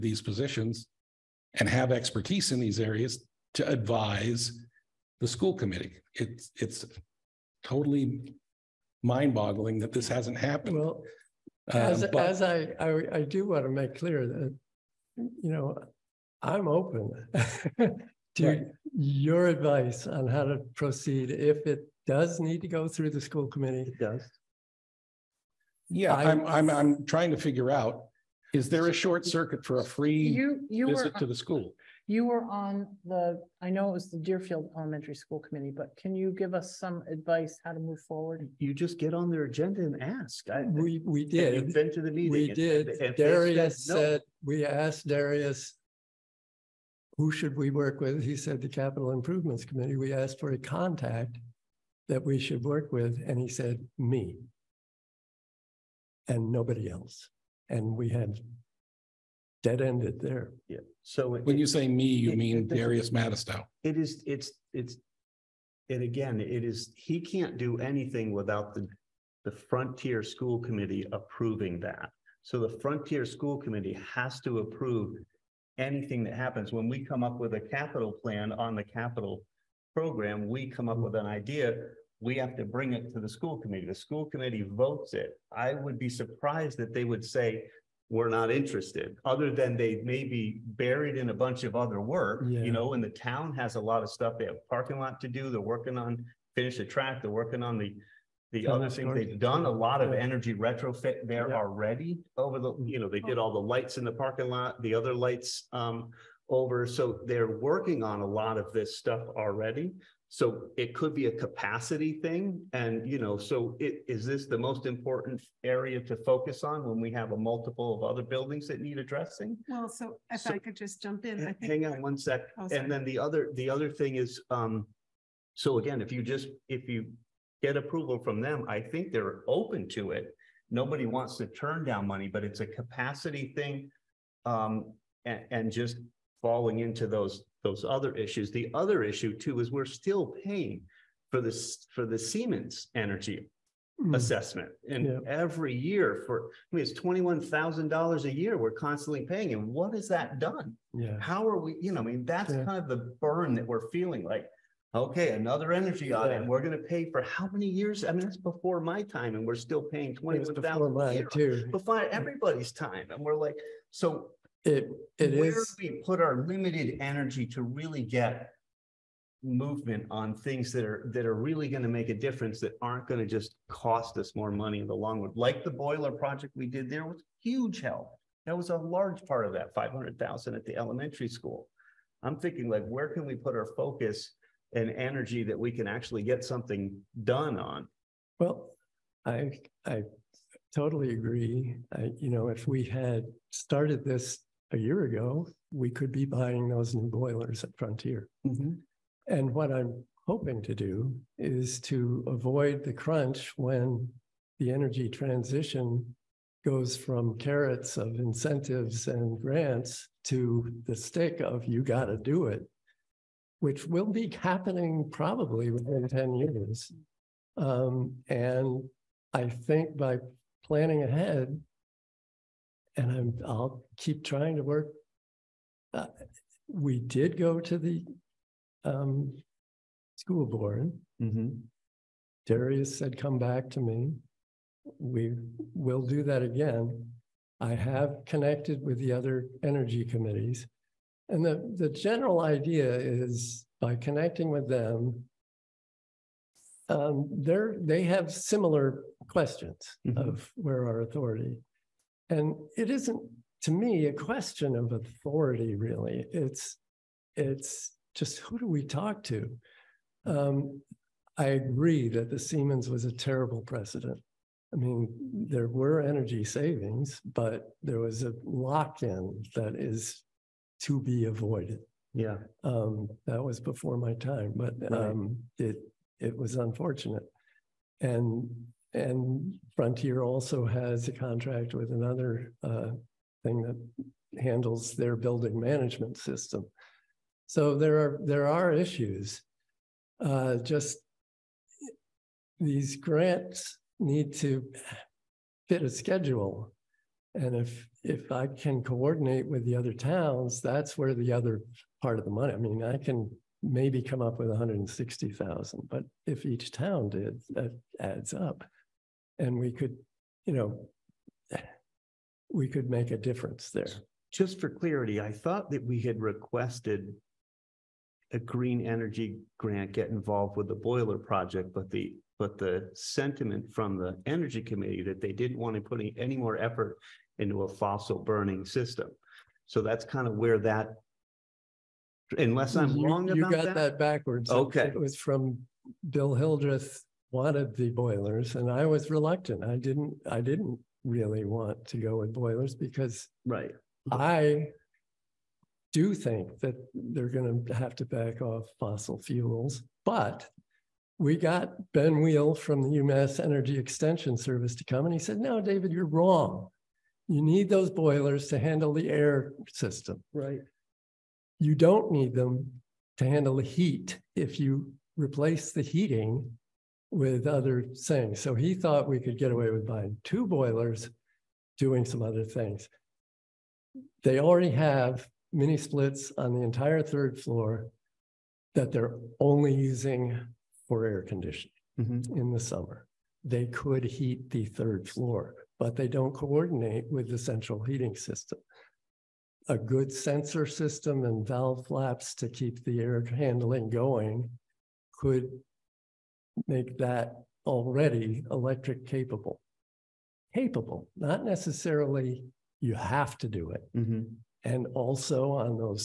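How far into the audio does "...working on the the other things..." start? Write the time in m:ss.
1:37.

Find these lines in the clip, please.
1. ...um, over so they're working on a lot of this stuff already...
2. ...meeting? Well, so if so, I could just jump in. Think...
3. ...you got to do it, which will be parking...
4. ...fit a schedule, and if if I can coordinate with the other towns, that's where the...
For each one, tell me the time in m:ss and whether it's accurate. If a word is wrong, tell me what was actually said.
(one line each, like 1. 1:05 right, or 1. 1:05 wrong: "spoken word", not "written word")
1. 1:45 right
2. 1:58 wrong: "addressing", not "meeting"
3. 3:31 wrong: "happening", not "parking"
4. 4:55 right.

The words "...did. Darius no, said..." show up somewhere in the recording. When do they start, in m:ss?
0:42.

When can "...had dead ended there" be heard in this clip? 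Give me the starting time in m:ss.
0:58.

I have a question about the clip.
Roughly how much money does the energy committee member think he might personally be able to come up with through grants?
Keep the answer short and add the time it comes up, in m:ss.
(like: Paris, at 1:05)
$160,000, at 5:04.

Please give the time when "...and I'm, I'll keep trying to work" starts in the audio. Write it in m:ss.
3:42.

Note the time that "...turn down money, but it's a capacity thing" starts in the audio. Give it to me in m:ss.
2:11.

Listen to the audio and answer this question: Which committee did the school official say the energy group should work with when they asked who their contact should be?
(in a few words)
Capital Improvements Committee.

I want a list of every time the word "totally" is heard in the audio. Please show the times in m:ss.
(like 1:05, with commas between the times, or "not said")
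0:07, 3:10.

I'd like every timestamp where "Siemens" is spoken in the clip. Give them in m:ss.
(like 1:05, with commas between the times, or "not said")
2:22, 4:22.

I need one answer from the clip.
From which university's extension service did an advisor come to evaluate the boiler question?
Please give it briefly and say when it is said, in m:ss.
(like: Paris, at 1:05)
UMass, at 5:52.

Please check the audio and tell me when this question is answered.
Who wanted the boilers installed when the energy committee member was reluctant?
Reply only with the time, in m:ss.
5:36.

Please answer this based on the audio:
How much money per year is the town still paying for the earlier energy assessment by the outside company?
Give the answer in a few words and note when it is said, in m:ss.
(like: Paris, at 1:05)
$21,000, at 2:26.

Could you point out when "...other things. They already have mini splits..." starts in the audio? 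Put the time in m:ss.
6:12.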